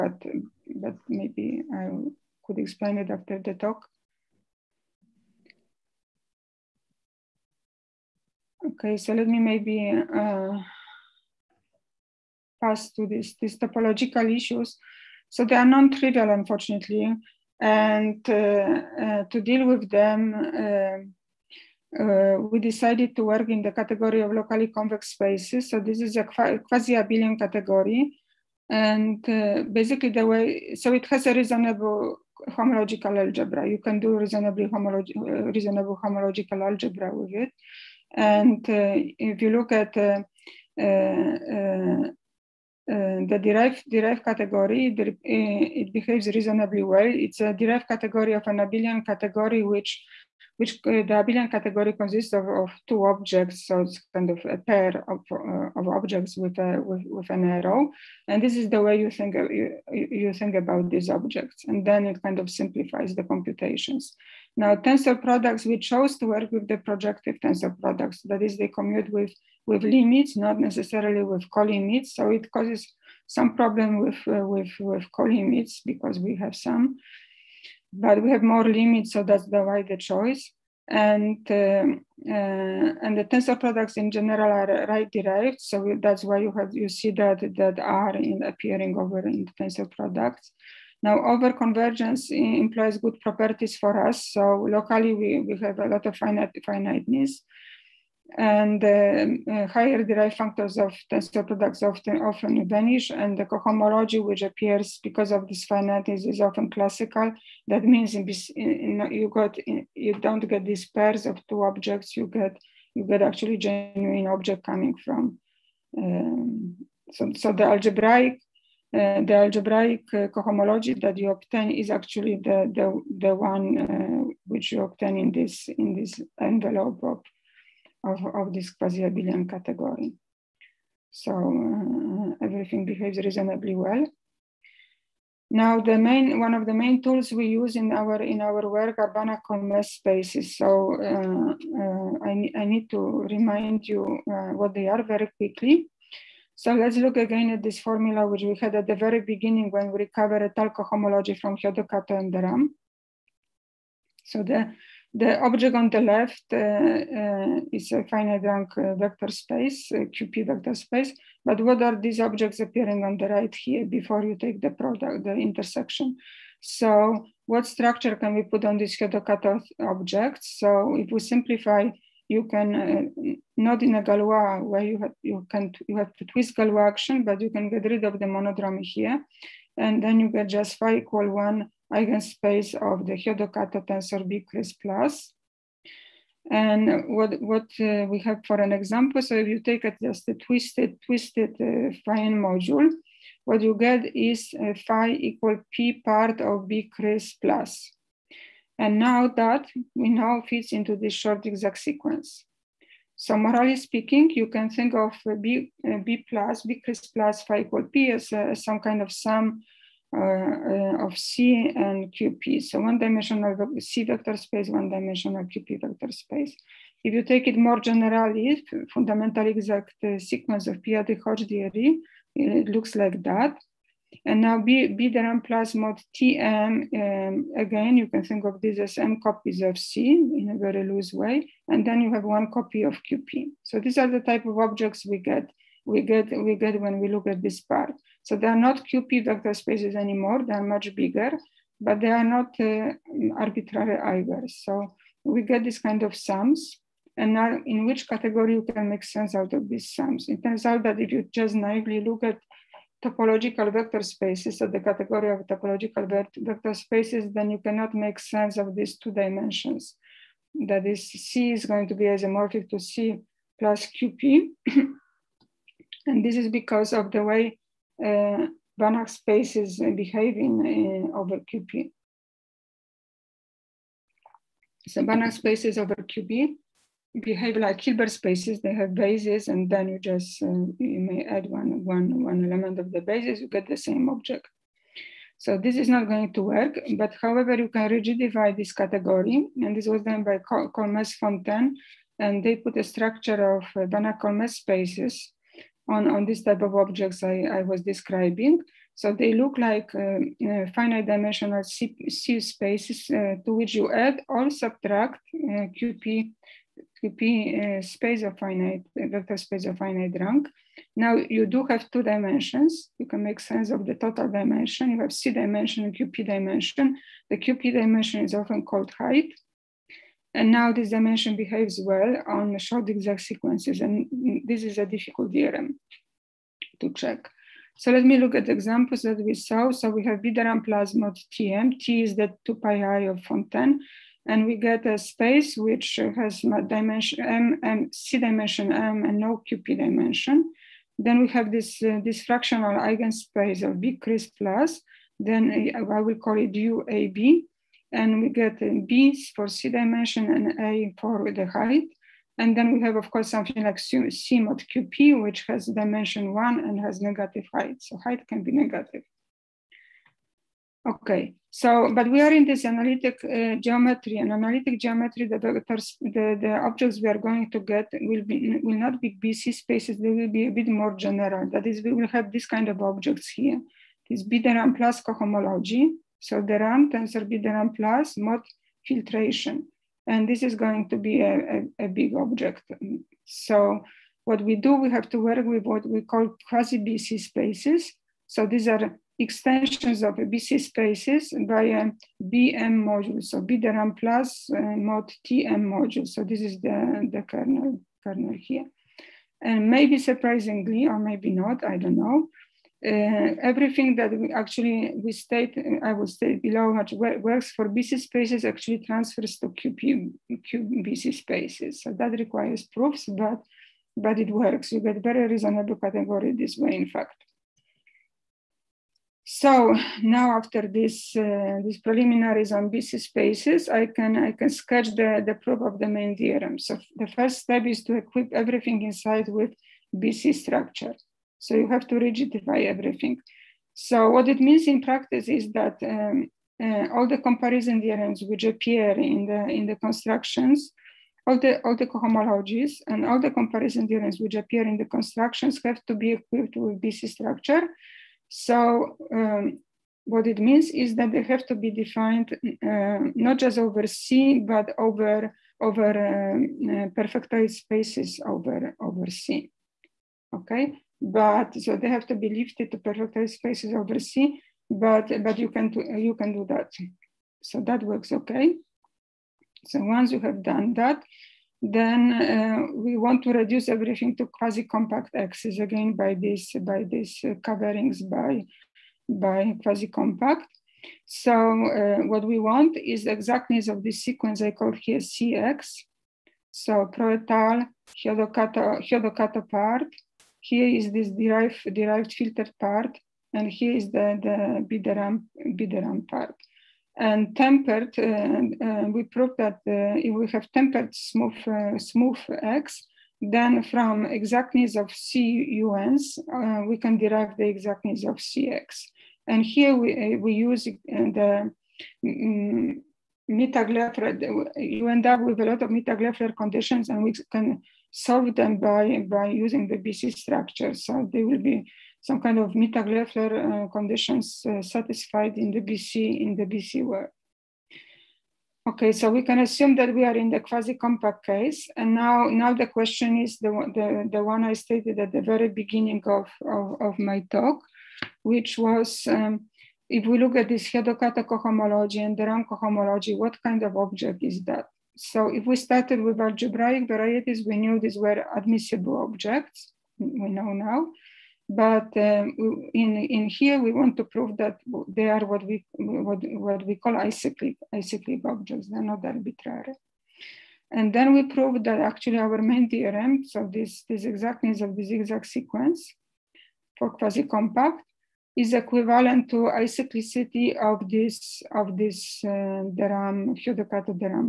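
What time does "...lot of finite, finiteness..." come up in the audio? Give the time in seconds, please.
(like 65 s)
95 s.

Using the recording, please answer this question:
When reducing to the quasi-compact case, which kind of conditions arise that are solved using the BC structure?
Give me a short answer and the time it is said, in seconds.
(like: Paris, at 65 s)
Mittag-Leffler conditions, at 515 s.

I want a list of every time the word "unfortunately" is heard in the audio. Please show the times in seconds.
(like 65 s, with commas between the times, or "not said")
16 s.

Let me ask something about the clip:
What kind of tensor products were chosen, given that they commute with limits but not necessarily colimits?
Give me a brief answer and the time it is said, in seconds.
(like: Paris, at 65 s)
projective tensor products, at 66 s.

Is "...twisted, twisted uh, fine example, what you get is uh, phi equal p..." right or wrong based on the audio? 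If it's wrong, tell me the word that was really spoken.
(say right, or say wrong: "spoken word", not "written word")
wrong: "module", not "example".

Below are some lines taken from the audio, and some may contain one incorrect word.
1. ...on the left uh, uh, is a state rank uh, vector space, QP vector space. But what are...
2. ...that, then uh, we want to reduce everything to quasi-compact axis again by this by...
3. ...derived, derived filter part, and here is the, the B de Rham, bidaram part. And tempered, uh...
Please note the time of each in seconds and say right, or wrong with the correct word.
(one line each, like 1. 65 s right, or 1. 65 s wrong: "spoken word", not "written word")
1. 155 s wrong: "finite", not "state"
2. 470 s right
3. 491 s right.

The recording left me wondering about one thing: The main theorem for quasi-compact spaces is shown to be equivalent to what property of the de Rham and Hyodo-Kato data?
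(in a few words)
acyclicity.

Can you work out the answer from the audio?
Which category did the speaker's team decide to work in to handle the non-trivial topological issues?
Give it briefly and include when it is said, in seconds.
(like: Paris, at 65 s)
locally convex spaces, at 24 s.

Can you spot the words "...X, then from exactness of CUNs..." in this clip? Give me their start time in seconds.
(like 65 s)
502 s.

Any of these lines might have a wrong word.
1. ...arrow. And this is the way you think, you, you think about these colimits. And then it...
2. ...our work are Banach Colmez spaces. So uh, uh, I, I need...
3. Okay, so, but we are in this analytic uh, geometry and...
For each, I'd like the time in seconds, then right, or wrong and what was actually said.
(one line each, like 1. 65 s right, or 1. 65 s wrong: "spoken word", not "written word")
1. 57 s wrong: "objects", not "colimits"
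2. 138 s right
3. 360 s right.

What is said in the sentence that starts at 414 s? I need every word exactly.
You get very reasonable category this way, in fact.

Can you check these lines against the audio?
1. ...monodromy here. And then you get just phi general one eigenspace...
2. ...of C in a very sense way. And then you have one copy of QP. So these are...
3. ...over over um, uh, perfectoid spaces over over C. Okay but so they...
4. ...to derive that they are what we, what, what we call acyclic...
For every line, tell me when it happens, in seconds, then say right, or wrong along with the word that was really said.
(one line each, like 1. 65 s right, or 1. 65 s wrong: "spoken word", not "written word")
1. 178 s wrong: "equal", not "general"
2. 229 s wrong: "loose", not "sense"
3. 454 s right
4. 553 s wrong: "prove", not "derive".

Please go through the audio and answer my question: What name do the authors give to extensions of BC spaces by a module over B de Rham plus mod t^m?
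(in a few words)
quasi-BC spaces.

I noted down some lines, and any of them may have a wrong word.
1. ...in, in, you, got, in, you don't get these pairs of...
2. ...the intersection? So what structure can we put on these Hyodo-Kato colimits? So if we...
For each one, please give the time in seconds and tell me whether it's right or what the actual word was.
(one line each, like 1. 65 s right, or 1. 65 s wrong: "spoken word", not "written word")
1. 108 s right
2. 165 s wrong: "objects", not "colimits".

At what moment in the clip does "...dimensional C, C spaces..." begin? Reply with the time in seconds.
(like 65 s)
301 s.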